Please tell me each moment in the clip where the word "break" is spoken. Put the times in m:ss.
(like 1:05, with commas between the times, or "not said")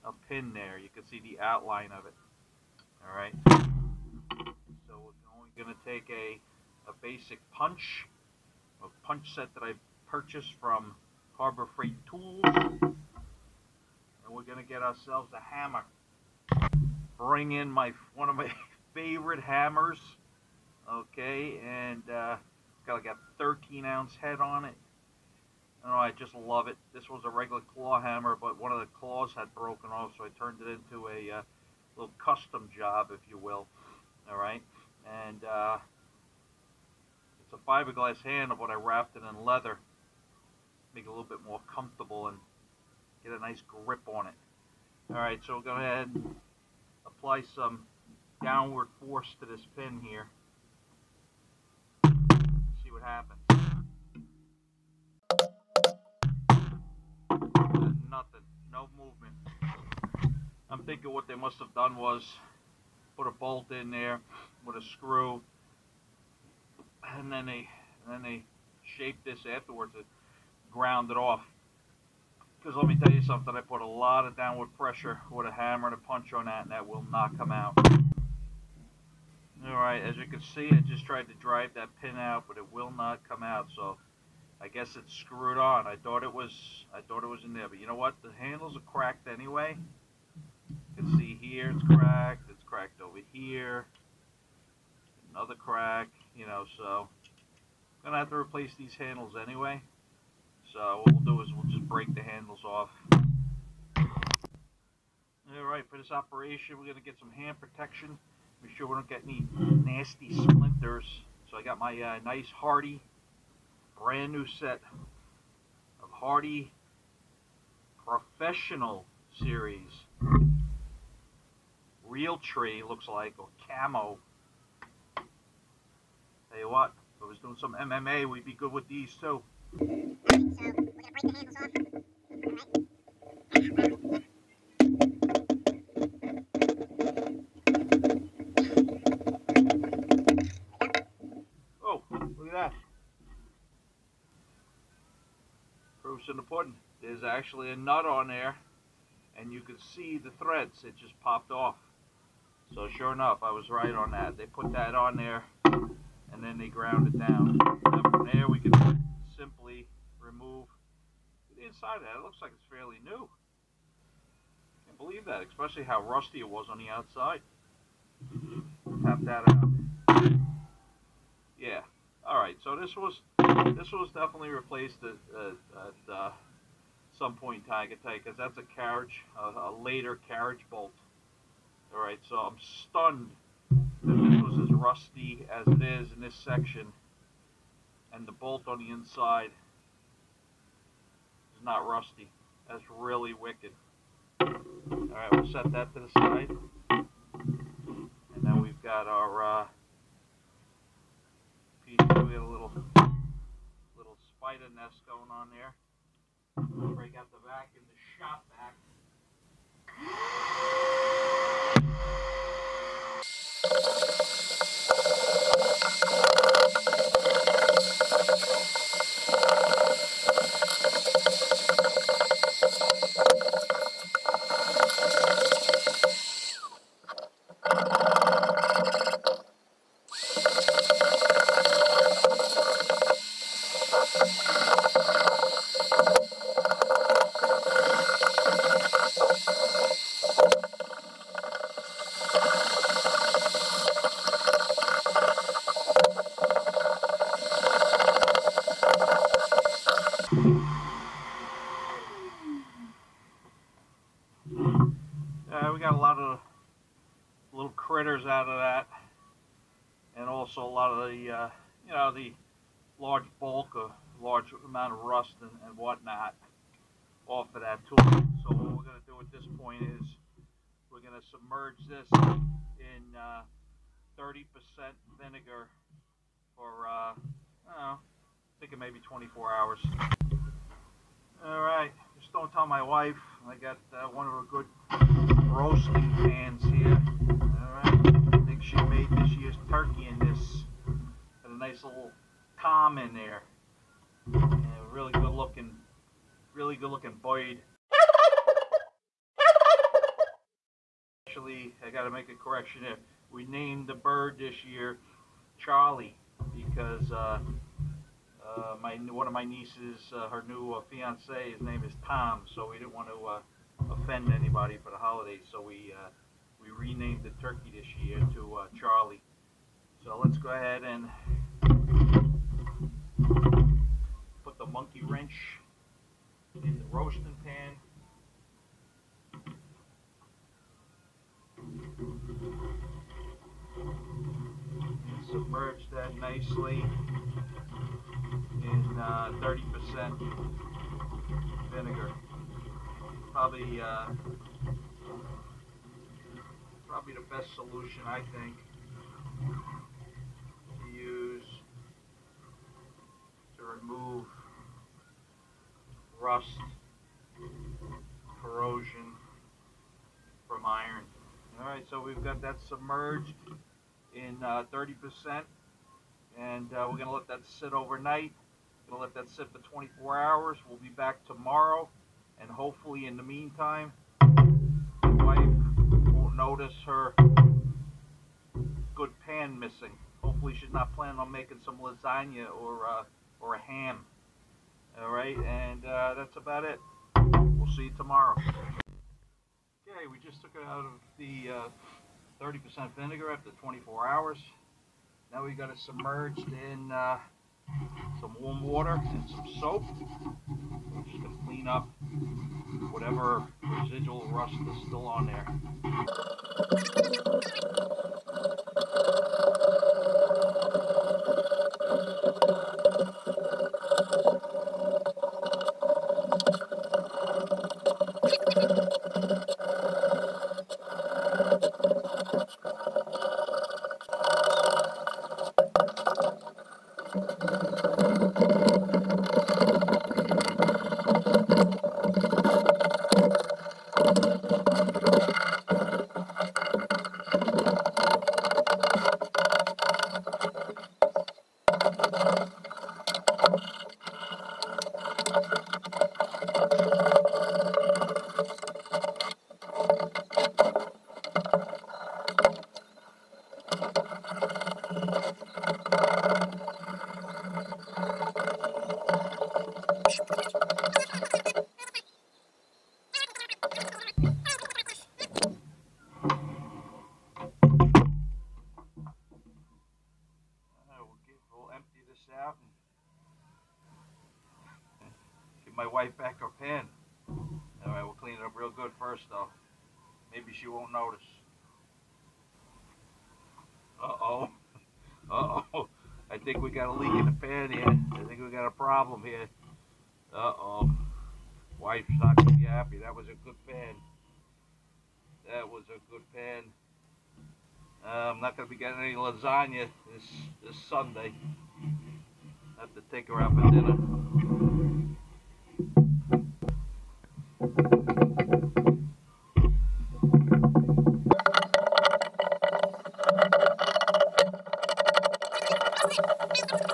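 1:41, 3:26.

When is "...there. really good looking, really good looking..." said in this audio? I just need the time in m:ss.
4:53.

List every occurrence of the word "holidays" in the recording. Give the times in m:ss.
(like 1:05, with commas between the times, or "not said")
5:14.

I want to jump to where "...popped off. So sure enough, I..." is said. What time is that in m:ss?
2:31.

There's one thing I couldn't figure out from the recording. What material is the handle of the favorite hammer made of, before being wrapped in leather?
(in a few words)
Fiberglass.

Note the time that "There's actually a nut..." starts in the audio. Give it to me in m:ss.
2:27.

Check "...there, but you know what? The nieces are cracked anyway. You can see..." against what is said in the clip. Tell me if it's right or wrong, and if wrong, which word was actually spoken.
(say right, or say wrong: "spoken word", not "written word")
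wrong: "handles", not "nieces".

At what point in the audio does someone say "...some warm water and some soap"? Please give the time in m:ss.
6:38.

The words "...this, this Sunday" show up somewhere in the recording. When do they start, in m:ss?
8:20.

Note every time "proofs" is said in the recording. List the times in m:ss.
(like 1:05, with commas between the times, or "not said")
2:26.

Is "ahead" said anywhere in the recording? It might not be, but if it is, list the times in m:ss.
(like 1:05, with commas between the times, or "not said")
0:45, 5:20.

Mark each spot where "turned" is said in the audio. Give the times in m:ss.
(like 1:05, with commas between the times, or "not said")
0:30.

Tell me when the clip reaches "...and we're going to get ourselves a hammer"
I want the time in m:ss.
0:14.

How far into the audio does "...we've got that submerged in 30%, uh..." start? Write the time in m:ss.
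6:01.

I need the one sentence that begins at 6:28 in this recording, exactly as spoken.
Okay, we just took it out of the 30% uh, vinegar after 24 hours.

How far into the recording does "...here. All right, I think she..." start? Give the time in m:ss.
4:46.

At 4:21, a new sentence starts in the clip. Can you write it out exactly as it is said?
the uh, you know the large bulk or large amount of rust and, and whatnot off of that tool.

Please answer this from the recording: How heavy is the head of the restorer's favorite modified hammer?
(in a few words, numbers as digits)
13 ounce.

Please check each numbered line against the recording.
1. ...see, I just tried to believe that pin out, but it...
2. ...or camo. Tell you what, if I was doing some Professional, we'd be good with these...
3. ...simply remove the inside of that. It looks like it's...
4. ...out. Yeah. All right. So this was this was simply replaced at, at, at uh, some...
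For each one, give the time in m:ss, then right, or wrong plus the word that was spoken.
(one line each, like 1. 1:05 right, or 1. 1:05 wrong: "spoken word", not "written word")
1. 1:20 wrong: "drive", not "believe"
2. 2:03 wrong: "MMA", not "Professional"
3. 2:39 right
4. 2:49 wrong: "definitely", not "simply".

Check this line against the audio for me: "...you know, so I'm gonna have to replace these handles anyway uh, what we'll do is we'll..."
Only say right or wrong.
right.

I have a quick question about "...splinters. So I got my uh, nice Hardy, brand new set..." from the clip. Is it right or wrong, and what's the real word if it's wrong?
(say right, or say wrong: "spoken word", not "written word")
right.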